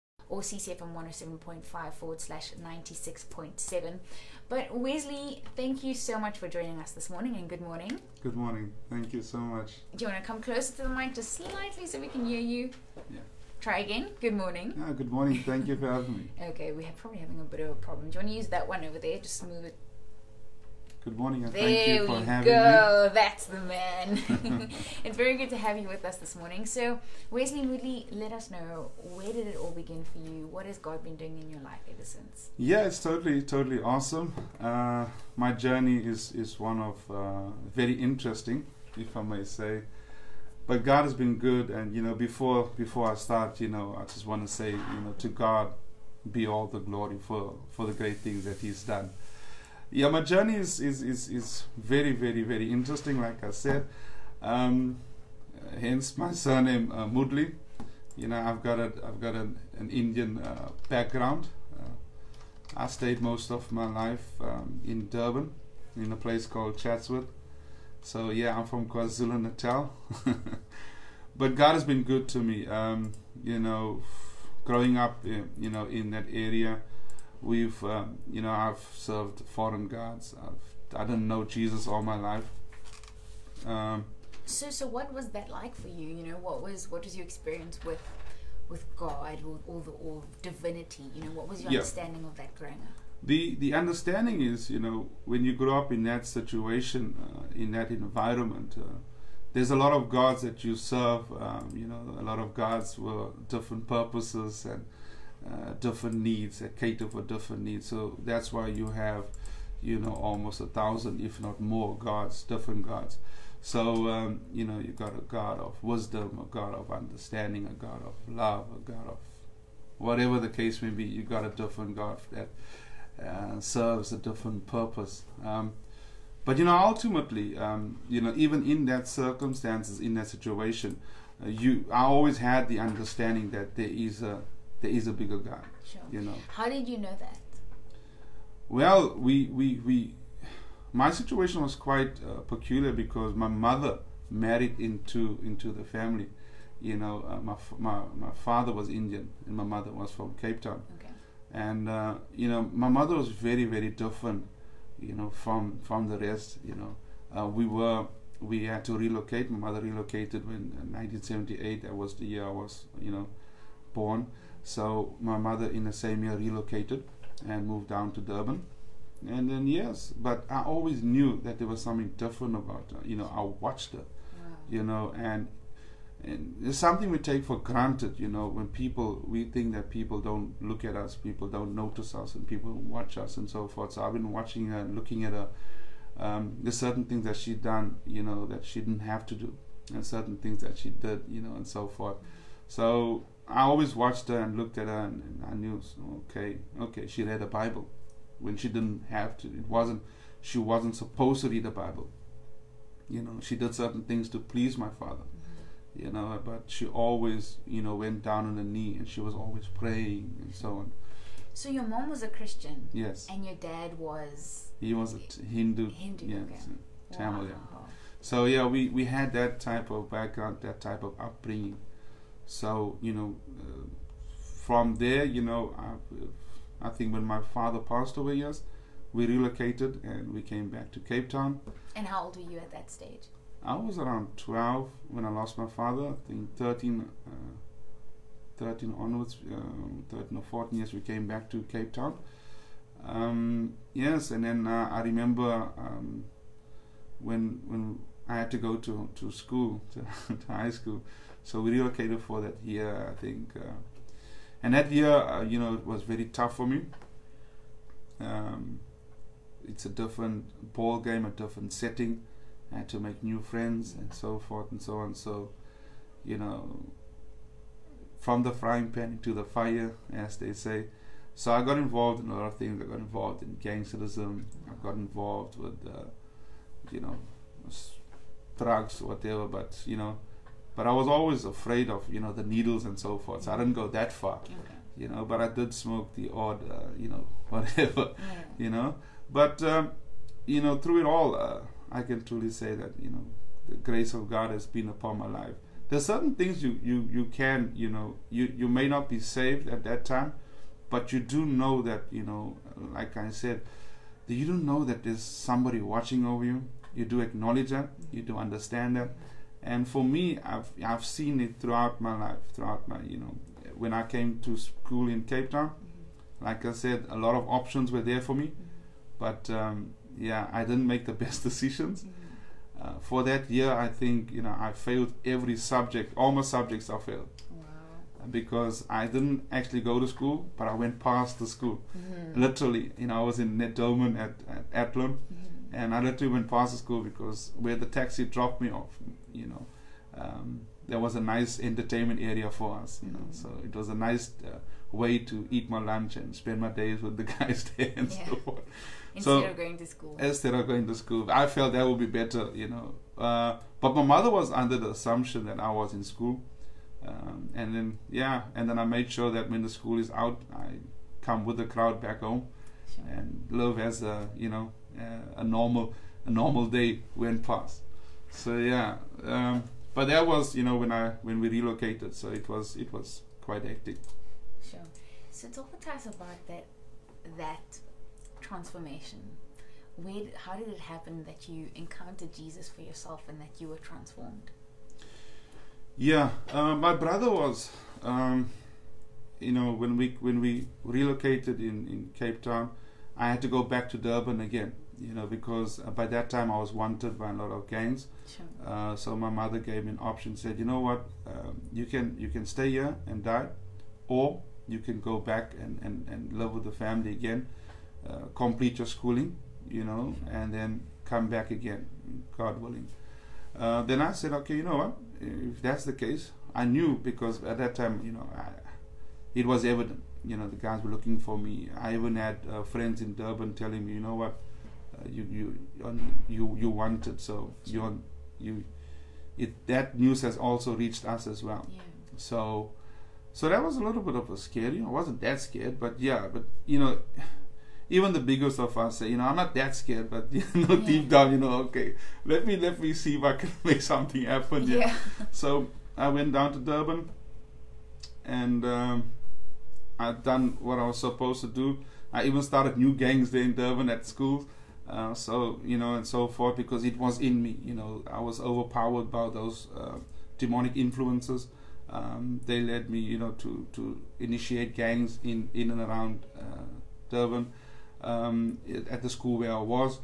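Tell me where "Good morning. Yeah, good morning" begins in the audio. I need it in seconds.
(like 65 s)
14 s.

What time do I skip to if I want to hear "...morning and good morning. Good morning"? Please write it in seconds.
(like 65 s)
7 s.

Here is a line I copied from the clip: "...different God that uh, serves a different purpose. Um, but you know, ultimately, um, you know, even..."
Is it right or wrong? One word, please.
right.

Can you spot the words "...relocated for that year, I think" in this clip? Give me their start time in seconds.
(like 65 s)
251 s.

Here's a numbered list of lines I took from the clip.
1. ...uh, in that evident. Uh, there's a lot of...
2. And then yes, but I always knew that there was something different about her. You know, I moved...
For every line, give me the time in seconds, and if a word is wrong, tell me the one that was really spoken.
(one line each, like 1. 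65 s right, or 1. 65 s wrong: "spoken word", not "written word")
1. 97 s wrong: "environment", not "evident"
2. 169 s wrong: "watched", not "moved".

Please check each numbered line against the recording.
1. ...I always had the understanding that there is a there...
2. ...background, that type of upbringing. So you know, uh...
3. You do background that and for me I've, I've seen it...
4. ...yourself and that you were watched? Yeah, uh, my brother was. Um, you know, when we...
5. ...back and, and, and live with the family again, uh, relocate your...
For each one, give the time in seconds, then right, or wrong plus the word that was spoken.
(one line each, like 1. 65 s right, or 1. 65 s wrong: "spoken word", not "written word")
1. 131 s right
2. 220 s right
3. 308 s wrong: "understand", not "background"
4. 382 s wrong: "transformed", not "watched"
5. 405 s wrong: "complete", not "relocate".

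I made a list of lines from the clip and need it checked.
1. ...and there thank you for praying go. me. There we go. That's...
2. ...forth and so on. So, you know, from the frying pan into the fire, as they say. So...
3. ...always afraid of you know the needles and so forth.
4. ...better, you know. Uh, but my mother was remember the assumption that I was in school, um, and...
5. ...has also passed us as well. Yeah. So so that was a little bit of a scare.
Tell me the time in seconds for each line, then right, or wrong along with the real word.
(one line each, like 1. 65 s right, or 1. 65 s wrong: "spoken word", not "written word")
1. 21 s wrong: "having", not "praying"
2. 264 s right
3. 281 s right
4. 352 s wrong: "under", not "remember"
5. 430 s wrong: "reached", not "passed".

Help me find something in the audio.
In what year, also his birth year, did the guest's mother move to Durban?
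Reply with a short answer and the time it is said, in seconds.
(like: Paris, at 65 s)
1978, at 160 s.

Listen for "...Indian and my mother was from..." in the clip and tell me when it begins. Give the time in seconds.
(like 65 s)
148 s.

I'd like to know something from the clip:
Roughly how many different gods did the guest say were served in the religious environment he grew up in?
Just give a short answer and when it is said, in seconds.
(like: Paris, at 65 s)
almost a thousand, at 110 s.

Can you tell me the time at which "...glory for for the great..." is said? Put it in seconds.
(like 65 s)
46 s.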